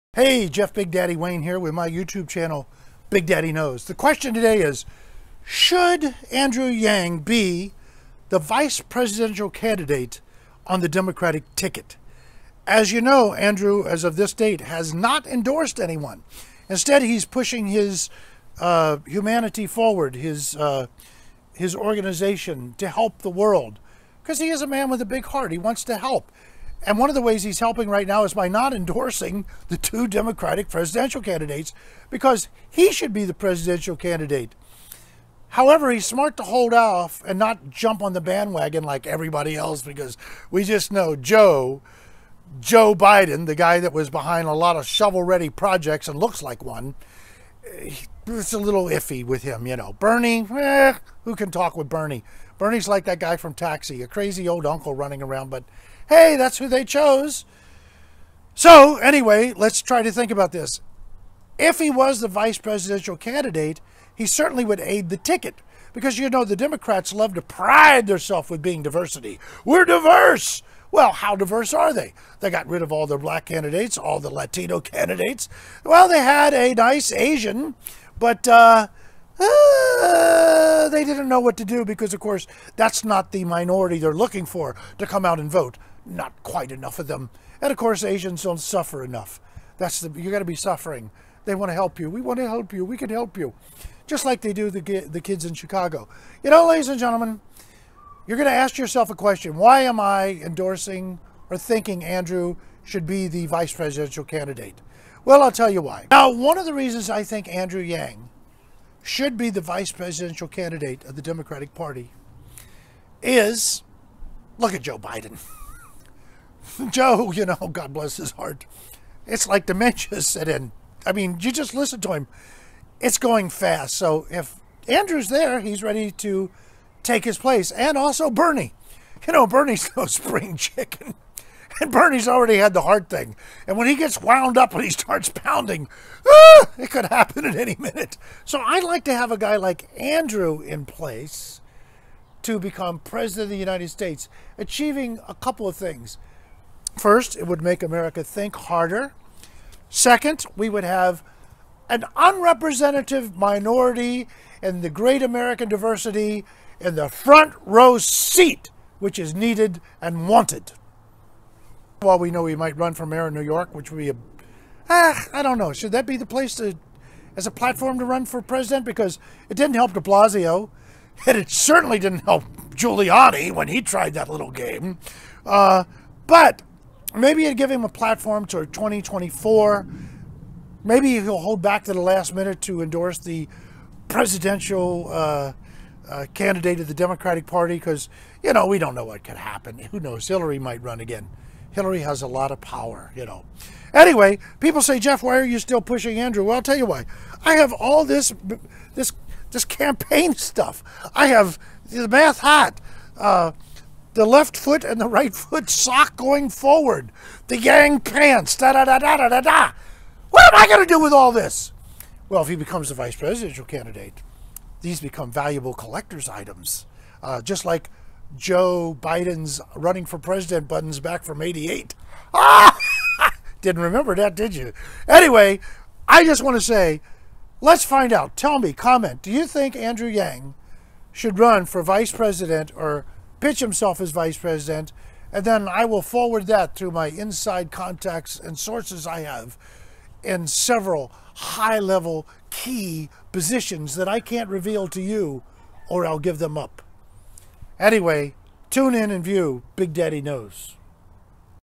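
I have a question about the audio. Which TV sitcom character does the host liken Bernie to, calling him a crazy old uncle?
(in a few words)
Taxi.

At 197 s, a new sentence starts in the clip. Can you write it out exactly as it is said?
I have all this, this, this campaign stuff.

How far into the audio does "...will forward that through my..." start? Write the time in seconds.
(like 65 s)
235 s.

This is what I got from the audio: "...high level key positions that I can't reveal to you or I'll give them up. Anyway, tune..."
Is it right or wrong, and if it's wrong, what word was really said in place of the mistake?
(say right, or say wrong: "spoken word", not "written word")
right.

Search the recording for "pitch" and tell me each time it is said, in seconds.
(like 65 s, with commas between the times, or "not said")
233 s.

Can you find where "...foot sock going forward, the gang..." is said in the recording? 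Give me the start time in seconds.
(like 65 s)
205 s.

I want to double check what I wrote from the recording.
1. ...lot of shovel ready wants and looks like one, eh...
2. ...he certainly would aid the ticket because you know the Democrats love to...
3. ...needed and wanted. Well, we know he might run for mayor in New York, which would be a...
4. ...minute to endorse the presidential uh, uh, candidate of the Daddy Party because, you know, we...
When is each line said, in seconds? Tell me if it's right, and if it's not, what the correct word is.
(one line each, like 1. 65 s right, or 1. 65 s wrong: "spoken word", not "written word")
1. 44 s wrong: "projects", not "wants"
2. 64 s right
3. 159 s right
4. 182 s wrong: "Democratic", not "Daddy".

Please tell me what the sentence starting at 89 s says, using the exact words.
That's the you got to be suffering.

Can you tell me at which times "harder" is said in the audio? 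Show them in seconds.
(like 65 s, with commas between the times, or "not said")
148 s.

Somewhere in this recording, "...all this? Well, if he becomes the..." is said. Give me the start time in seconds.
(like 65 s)
211 s.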